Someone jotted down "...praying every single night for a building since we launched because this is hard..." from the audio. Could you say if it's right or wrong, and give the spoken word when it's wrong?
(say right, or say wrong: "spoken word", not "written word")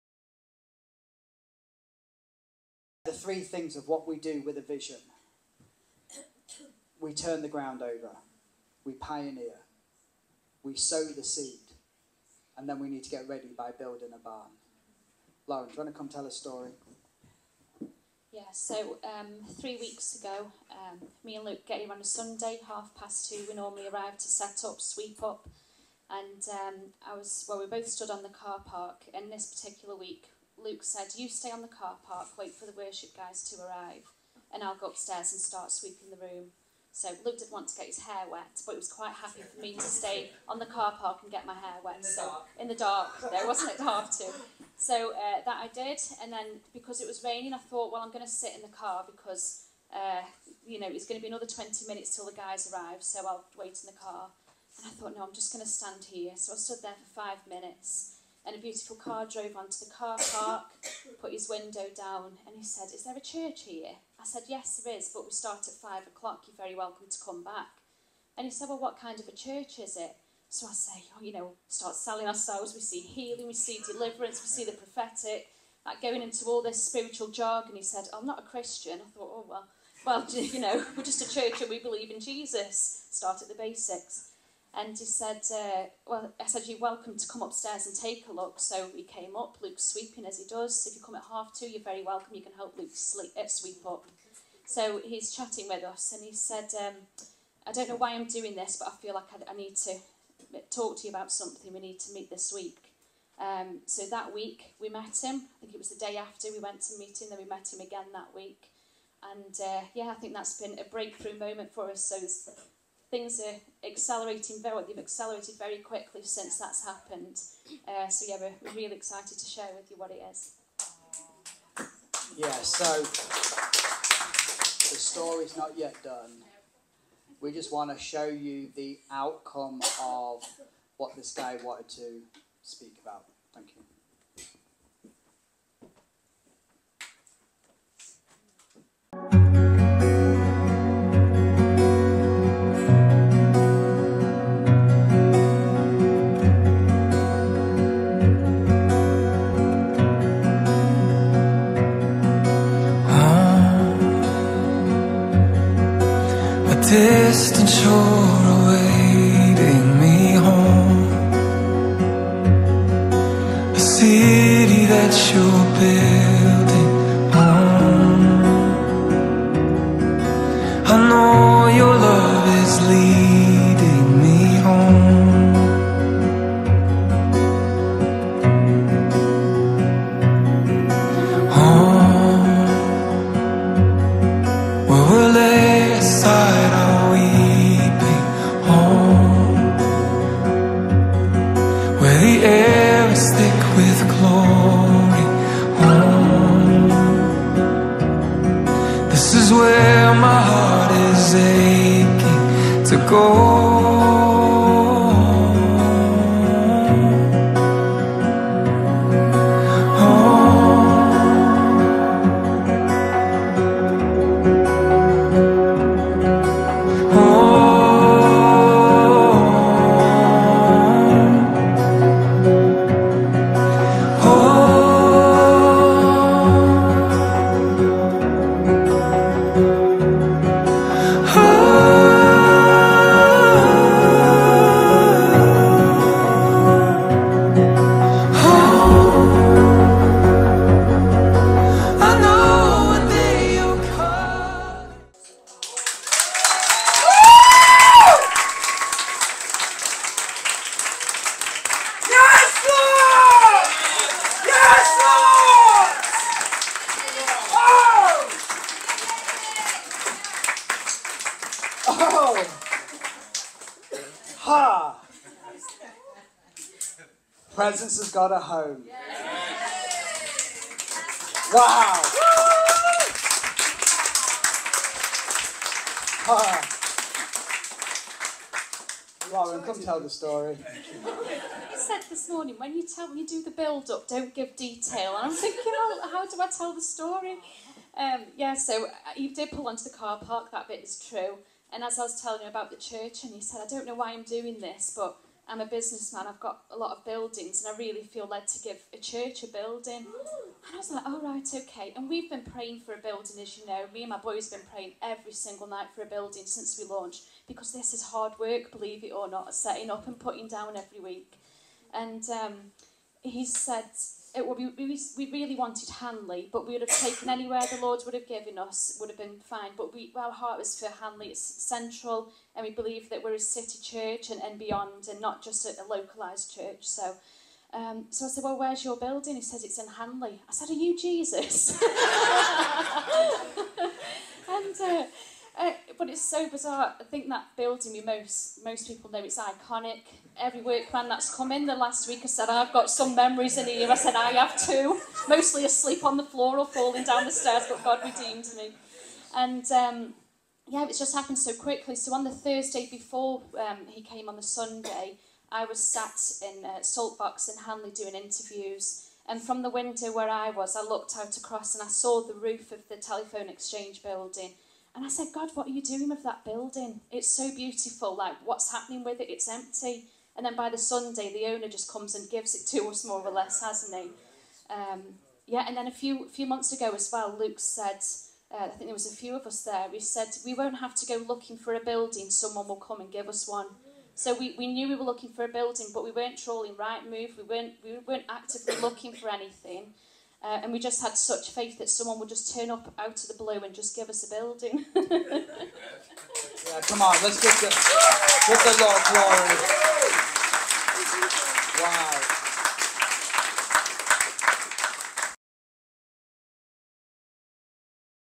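right.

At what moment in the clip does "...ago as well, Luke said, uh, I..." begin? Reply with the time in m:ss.
6:16.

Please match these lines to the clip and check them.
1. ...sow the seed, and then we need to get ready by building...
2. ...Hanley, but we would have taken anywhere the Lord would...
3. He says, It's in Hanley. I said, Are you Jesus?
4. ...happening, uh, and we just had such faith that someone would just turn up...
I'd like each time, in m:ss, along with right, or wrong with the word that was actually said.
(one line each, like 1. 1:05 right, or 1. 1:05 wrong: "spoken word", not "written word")
1. 0:10 right
2. 5:15 right
3. 5:29 right
4. 6:29 wrong: "anything", not "happening".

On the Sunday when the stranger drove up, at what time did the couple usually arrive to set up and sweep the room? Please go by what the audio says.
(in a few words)
half past two.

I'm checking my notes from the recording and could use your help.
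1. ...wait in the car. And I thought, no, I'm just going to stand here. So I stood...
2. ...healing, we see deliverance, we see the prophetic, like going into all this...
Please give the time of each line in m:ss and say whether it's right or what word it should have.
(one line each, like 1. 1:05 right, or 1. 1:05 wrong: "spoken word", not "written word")
1. 0:53 right
2. 1:12 right.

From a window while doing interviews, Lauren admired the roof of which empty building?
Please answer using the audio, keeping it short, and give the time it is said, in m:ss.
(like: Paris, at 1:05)
telephone exchange, at 6:02.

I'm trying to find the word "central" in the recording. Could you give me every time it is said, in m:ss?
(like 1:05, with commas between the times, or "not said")
5:21.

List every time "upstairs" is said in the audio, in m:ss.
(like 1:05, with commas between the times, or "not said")
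0:34, 1:27.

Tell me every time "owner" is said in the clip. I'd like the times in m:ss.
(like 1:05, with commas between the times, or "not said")
6:11.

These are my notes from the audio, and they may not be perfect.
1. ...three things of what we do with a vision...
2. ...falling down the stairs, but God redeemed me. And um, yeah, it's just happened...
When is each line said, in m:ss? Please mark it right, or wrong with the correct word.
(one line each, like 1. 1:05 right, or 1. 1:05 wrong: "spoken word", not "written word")
1. 0:03 right
2. 5:46 right.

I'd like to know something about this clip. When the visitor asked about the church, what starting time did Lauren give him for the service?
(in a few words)
5 o'clock.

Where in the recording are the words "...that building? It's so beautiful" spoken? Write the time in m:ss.
6:06.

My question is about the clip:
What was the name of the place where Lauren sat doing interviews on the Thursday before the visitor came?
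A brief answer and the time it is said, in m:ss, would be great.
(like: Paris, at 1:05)
Saltbox, at 5:56.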